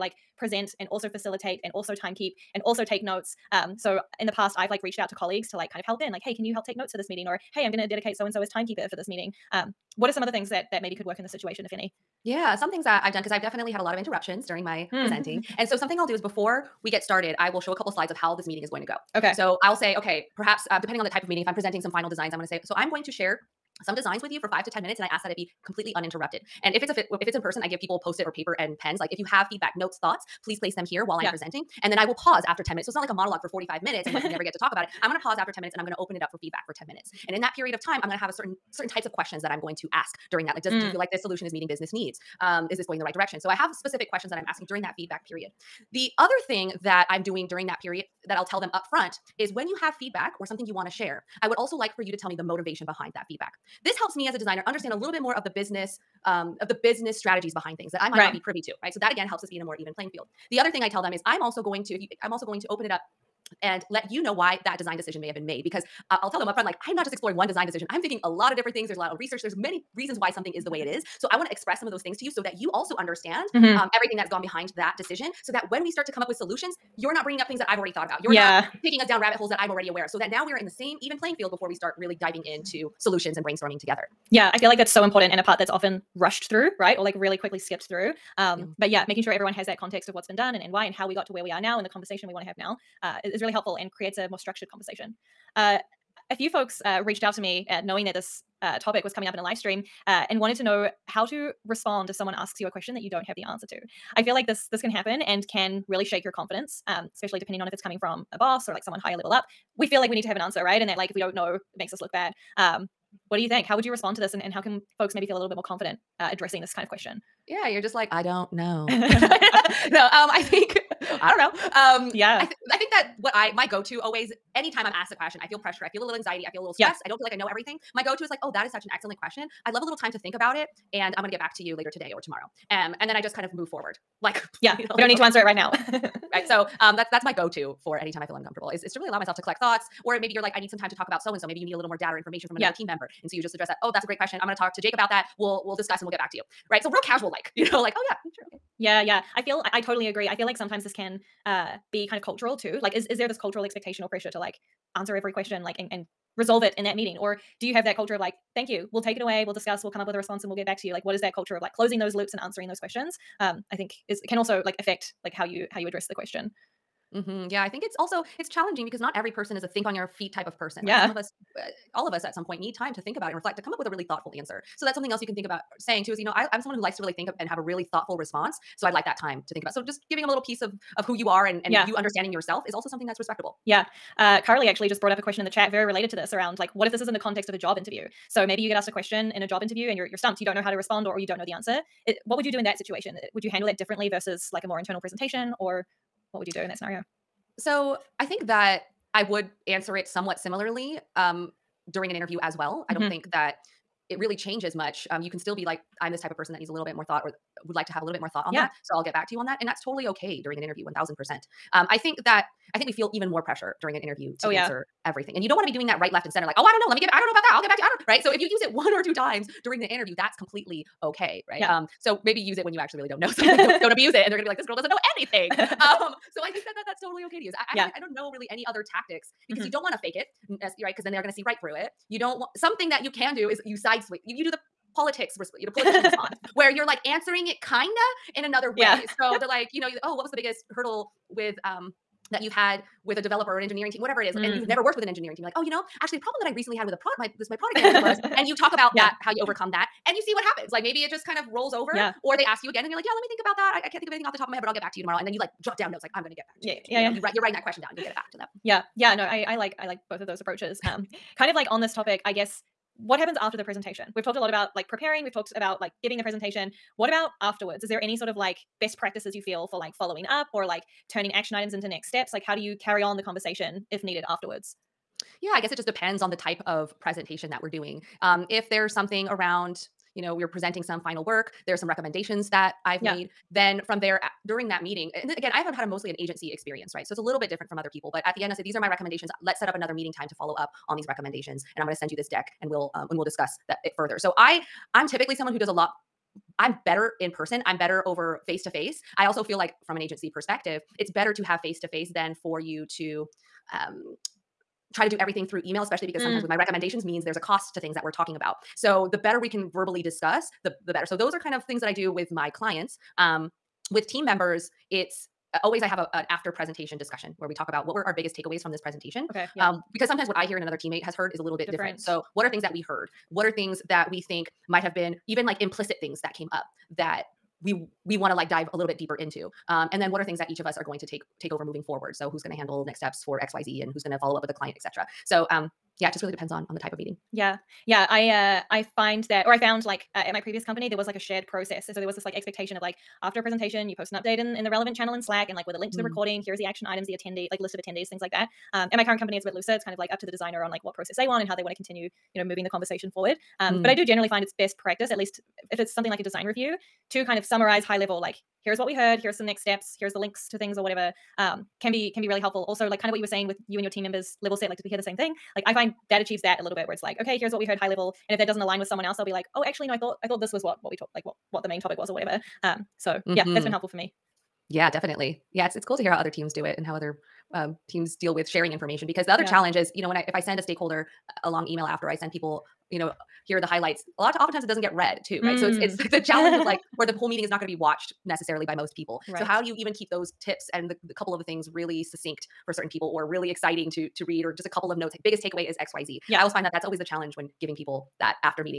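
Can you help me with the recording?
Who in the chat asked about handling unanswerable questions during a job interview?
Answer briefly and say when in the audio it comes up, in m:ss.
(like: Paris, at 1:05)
Carly, at 3:04.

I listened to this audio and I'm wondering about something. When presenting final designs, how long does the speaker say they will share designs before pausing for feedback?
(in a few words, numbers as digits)
5 to 10 minutes.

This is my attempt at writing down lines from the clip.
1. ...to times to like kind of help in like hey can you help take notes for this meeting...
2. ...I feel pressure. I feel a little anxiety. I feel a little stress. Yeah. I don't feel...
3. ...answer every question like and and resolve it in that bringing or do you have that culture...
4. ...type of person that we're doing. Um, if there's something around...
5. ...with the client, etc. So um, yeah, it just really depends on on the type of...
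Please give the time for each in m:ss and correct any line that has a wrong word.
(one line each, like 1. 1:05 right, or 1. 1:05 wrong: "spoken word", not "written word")
1. 0:05 wrong: "colleagues", not "times"
2. 2:05 right
3. 2:34 wrong: "meeting", not "bringing"
4. 4:36 wrong: "presentation", not "person"
5. 5:34 right.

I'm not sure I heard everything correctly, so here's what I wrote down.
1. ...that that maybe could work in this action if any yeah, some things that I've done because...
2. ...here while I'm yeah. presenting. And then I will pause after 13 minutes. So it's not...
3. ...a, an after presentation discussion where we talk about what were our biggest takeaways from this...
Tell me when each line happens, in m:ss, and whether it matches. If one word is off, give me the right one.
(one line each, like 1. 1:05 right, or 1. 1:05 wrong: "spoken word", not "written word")
1. 0:10 wrong: "situation", not "action"
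2. 0:30 wrong: "10", not "13"
3. 5:15 right.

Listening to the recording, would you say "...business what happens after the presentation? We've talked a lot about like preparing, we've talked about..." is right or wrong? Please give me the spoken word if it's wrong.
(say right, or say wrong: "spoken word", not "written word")
wrong: "guess", not "business".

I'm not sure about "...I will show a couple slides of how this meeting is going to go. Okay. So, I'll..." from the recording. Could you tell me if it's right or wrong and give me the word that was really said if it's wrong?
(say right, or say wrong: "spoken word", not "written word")
right.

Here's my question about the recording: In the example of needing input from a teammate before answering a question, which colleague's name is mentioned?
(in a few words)
Jake.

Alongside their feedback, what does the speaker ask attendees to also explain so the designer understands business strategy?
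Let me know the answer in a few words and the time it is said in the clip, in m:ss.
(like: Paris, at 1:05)
The motivation, at 0:52.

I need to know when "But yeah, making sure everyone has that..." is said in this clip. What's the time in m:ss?
1:28.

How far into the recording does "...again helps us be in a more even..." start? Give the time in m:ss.
0:59.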